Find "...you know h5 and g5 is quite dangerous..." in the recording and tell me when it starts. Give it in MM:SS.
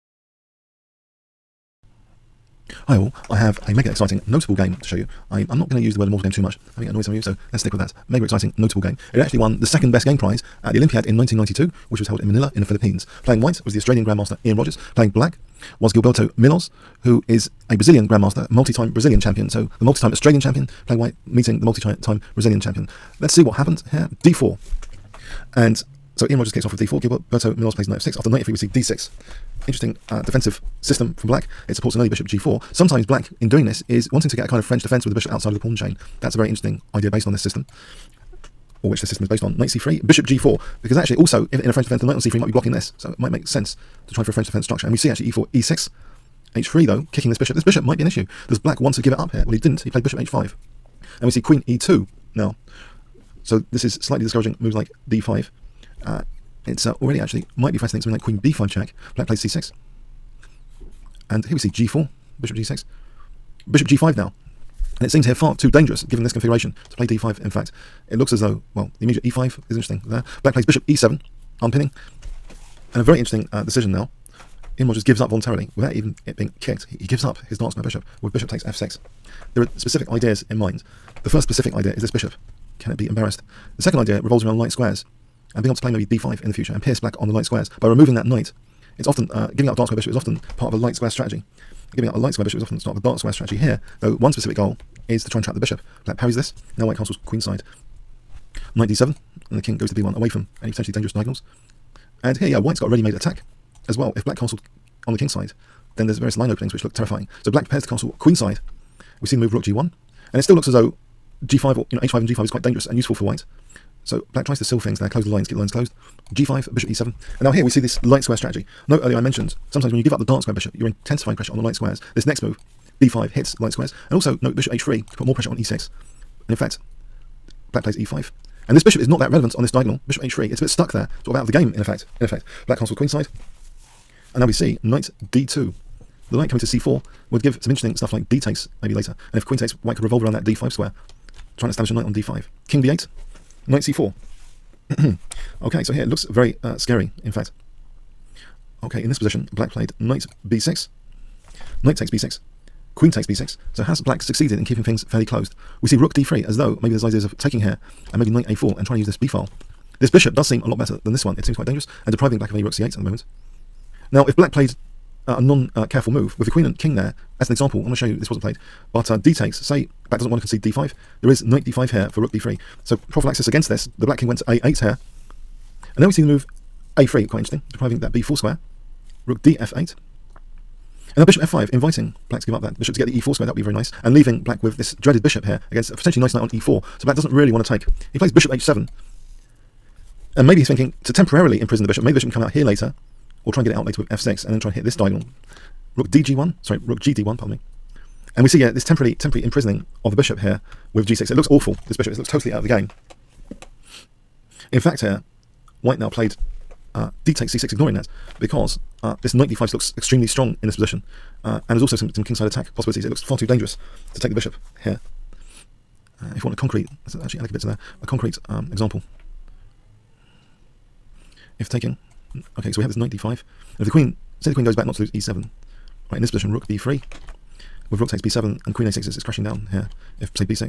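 01:51.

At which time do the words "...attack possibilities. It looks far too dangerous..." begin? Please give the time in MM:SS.
03:32.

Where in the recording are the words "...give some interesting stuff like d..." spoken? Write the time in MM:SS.
02:17.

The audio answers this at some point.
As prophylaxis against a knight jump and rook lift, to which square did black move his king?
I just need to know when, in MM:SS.
02:54.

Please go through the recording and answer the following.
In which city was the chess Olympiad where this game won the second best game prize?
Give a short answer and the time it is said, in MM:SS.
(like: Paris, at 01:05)
Manila, at 00:12.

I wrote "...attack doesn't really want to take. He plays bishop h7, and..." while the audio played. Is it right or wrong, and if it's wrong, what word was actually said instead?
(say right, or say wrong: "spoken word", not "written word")
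wrong: "black", not "attack".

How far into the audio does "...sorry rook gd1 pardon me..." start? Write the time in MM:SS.
03:16.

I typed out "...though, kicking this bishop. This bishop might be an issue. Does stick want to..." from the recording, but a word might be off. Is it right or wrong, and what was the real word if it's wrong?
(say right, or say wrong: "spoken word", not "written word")
wrong: "black", not "stick".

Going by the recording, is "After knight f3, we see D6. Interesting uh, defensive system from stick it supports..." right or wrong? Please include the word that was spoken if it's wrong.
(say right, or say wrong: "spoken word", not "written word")
wrong: "black", not "stick".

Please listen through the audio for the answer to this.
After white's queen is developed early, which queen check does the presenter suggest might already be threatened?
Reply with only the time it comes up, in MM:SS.
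00:58.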